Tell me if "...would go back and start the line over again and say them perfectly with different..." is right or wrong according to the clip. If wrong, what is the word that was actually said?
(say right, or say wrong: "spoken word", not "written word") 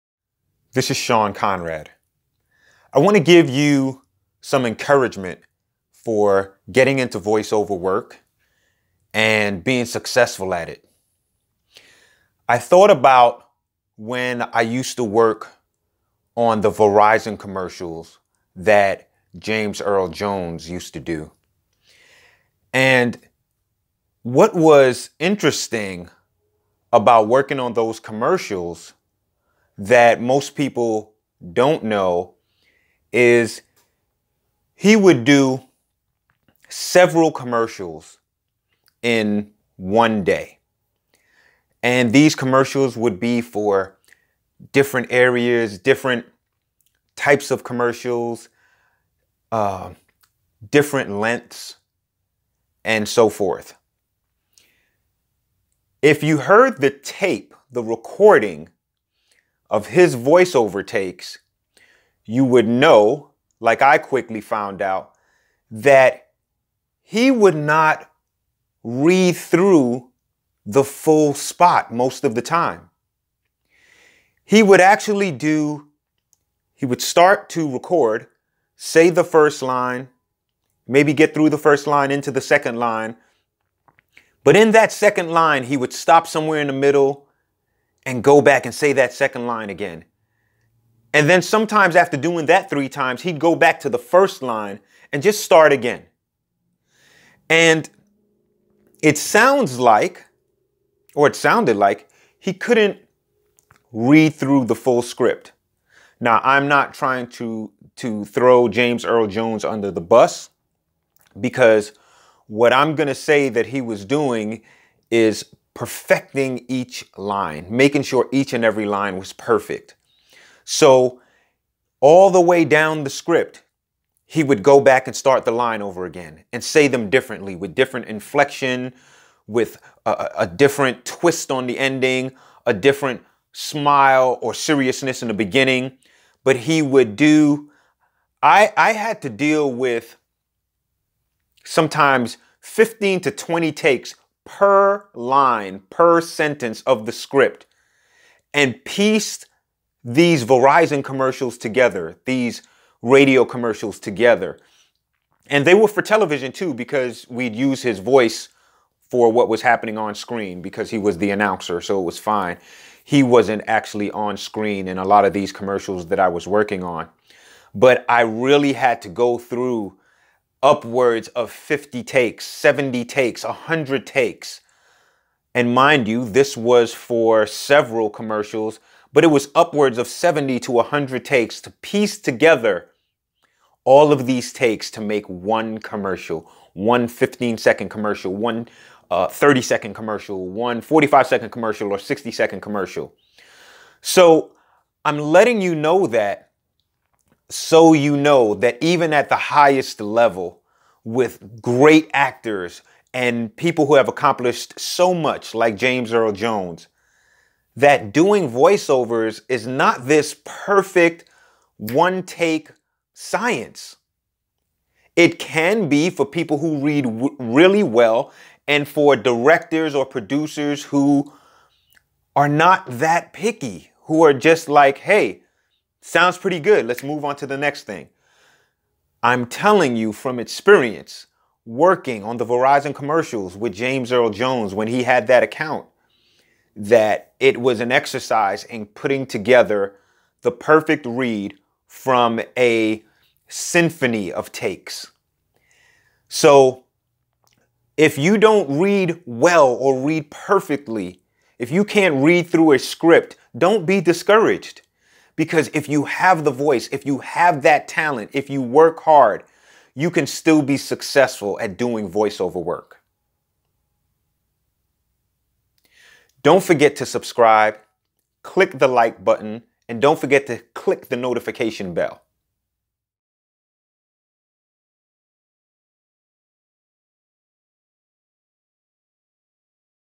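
wrong: "differently", not "perfectly".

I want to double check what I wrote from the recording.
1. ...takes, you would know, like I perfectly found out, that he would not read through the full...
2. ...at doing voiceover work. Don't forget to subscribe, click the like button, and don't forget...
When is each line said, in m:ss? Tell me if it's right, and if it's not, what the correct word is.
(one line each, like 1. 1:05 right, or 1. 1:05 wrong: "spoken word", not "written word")
1. 1:00 wrong: "quickly", not "perfectly"
2. 4:21 right.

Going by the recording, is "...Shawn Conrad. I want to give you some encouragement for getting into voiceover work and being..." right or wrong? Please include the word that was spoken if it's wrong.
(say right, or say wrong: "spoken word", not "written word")
right.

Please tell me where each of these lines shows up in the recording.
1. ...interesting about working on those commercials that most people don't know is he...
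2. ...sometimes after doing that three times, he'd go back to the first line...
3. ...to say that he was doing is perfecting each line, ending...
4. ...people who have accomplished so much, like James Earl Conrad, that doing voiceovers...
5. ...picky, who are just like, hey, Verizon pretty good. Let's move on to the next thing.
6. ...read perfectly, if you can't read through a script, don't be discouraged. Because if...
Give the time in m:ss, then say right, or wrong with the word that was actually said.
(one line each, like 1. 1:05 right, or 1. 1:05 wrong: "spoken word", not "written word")
1. 0:25 right
2. 1:31 right
3. 1:53 wrong: "making", not "ending"
4. 3:23 wrong: "Jones", not "Conrad"
5. 3:43 wrong: "Sounds", not "Verizon"
6. 4:09 right.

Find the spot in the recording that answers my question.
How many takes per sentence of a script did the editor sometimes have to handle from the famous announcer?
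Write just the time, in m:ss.
2:22.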